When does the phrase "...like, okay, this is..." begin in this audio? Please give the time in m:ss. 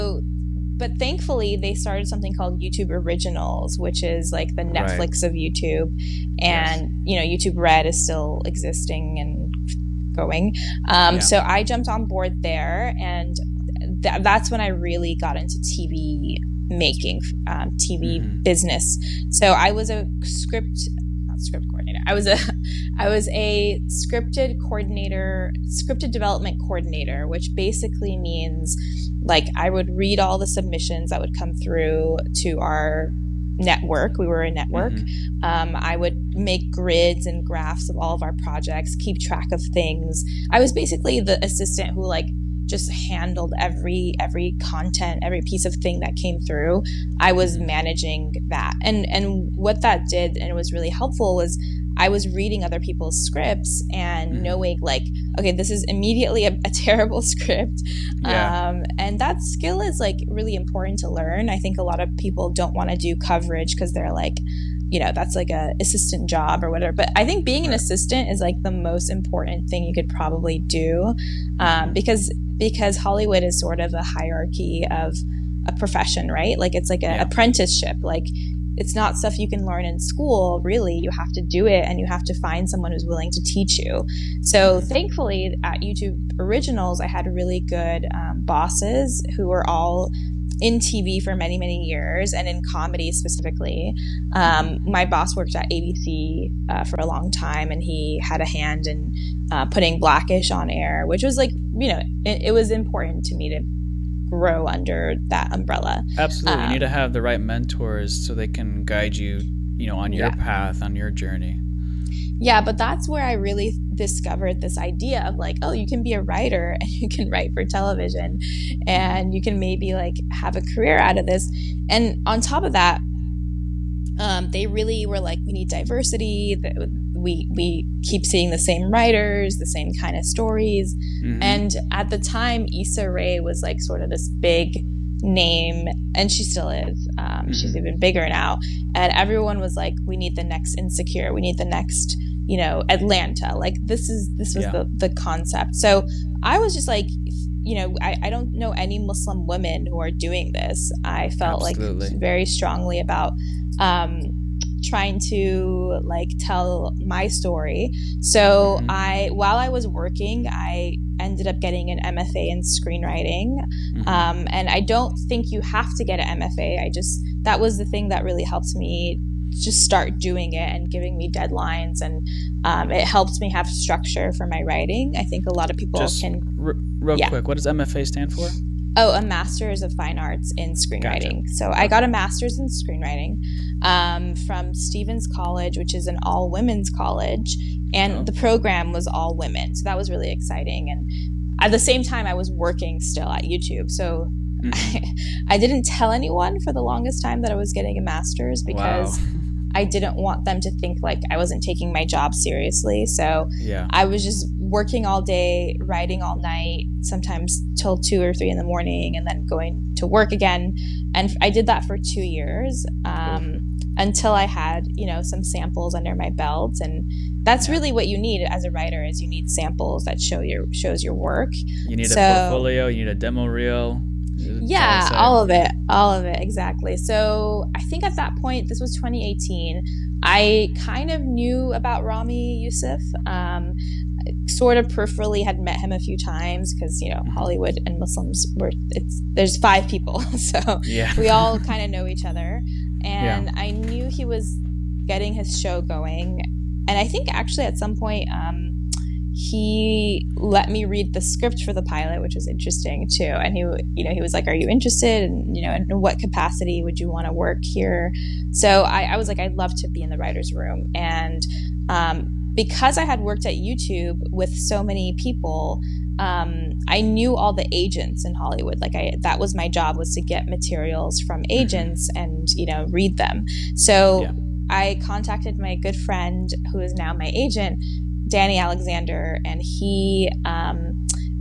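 0:54.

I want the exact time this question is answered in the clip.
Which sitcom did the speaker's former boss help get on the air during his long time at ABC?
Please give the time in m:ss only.
1:39.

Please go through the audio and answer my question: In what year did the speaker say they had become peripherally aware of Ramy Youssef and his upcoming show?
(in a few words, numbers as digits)
2018.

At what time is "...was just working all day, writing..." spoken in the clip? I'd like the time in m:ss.
3:24.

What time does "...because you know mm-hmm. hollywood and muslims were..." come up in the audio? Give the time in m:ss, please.
3:56.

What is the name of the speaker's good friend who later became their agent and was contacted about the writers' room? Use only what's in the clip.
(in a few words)
Danny Alexander.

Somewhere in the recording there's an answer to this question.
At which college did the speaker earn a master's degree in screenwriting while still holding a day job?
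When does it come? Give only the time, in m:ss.
3:04.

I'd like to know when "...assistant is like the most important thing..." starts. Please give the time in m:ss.
1:07.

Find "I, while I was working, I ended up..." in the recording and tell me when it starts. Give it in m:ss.
2:38.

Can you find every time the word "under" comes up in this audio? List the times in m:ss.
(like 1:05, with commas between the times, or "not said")
1:44, 3:35.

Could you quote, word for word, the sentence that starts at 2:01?
And on top of that, um, they really were like, we need diversity.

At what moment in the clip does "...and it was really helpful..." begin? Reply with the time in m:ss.
0:50.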